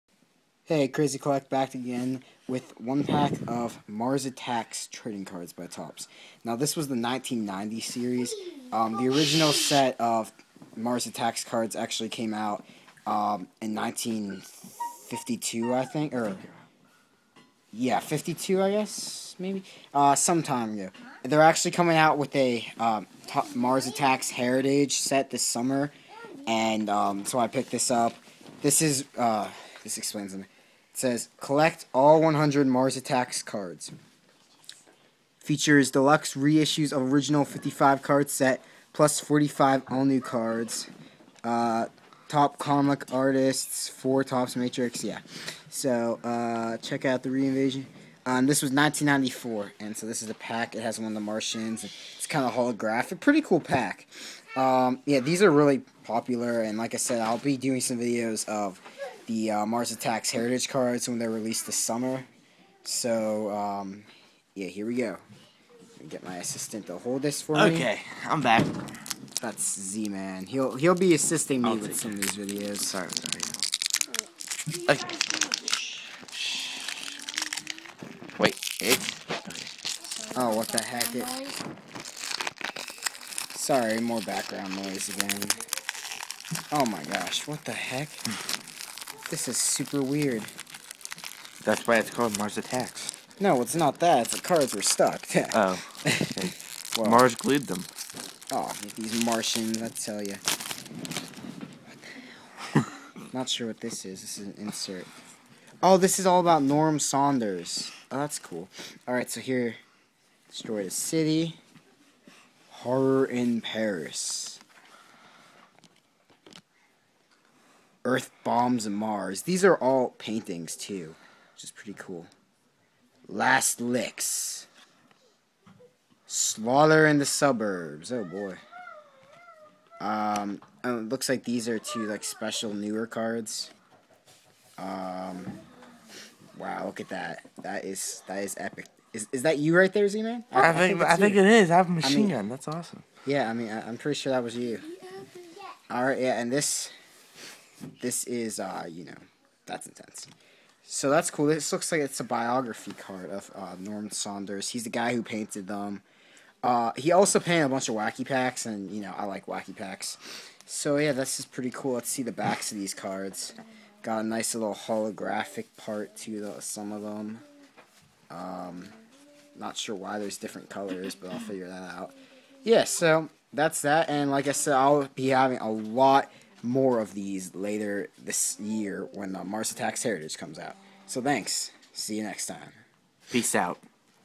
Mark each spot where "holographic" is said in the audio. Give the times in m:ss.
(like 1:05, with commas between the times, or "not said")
0:52, 2:44.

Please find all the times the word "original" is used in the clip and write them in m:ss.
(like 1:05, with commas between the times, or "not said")
0:09, 0:37.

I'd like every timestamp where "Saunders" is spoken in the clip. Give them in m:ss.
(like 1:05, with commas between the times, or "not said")
1:46, 2:34.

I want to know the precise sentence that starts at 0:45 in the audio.
So uh, check out the reinvasion.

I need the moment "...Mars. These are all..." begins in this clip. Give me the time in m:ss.
1:58.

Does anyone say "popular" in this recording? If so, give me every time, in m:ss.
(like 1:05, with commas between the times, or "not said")
0:56.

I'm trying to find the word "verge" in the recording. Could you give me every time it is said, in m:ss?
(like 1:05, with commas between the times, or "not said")
not said.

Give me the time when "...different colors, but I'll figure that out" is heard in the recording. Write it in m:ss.
2:50.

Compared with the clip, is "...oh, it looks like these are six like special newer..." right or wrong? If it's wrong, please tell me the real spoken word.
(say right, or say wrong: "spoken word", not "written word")
wrong: "two", not "six".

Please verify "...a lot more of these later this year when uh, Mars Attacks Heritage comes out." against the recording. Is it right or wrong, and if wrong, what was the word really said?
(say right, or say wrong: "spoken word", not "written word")
right.